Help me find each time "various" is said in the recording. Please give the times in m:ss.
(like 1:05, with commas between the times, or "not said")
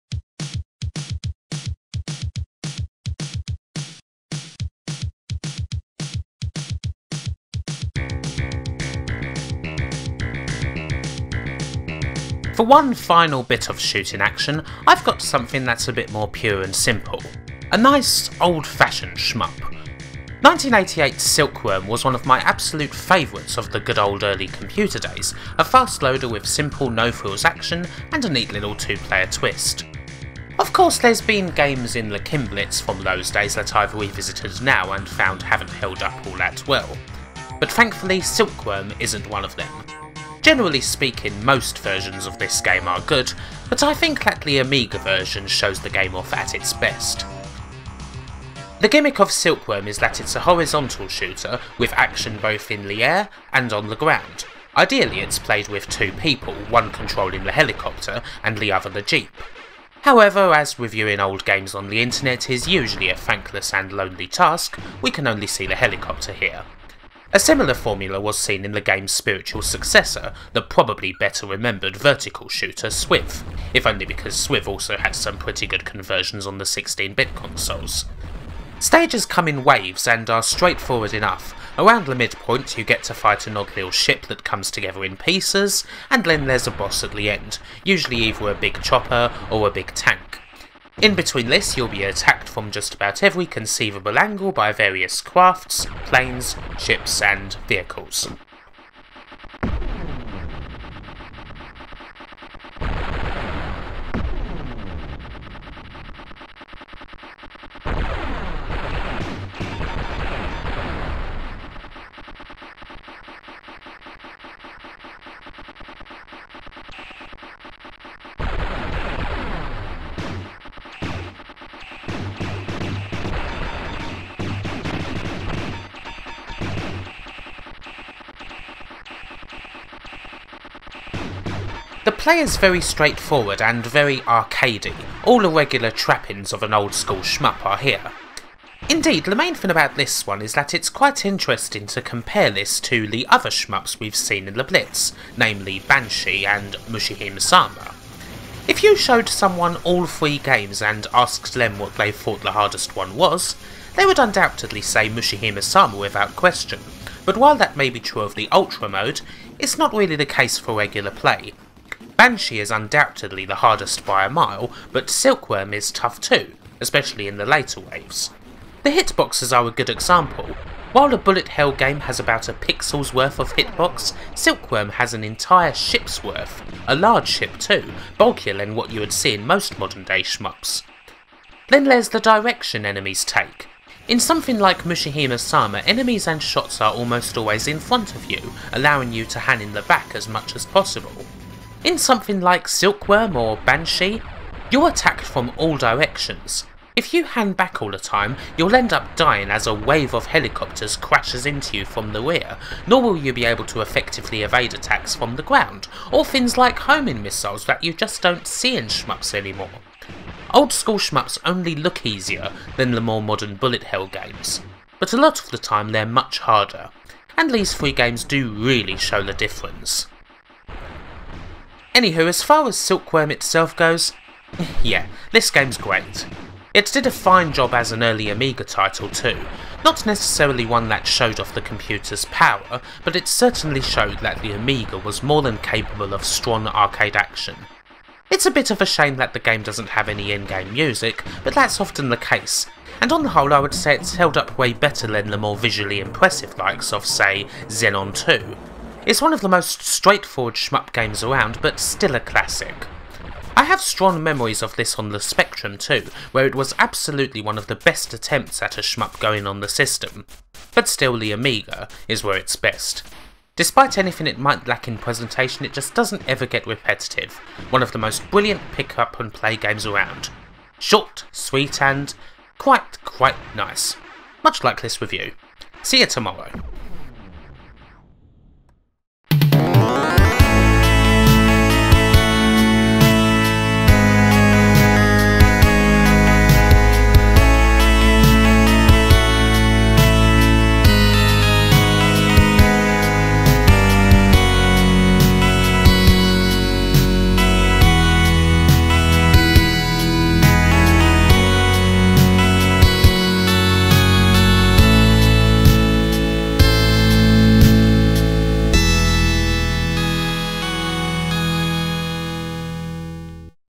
1:34.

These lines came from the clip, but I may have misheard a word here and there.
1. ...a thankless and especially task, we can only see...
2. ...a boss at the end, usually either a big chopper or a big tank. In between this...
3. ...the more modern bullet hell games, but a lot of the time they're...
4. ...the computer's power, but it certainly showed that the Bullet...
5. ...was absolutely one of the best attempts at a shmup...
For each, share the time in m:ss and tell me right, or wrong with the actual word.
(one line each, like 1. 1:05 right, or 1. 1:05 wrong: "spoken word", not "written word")
1. 1:03 wrong: "lonely", not "especially"
2. 1:26 right
3. 3:32 right
4. 3:51 wrong: "Amiga", not "Bullet"
5. 4:16 right.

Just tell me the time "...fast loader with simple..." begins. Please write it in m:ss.
0:25.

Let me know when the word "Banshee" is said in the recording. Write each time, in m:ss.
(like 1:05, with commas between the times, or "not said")
2:25, 2:42, 3:13.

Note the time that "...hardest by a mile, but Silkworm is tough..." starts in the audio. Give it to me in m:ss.
2:43.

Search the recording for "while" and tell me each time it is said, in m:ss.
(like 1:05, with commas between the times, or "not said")
2:37, 2:50.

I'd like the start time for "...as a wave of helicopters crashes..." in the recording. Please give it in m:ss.
3:19.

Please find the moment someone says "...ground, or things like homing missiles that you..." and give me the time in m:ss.
3:25.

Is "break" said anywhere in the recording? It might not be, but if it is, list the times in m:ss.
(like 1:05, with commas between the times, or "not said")
not said.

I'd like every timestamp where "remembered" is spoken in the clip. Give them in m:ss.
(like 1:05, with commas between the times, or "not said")
1:11.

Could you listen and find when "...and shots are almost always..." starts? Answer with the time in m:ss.
3:06.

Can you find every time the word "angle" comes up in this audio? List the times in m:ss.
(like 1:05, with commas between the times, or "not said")
1:34.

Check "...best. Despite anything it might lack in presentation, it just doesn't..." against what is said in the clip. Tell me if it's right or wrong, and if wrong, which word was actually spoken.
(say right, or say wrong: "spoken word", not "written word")
right.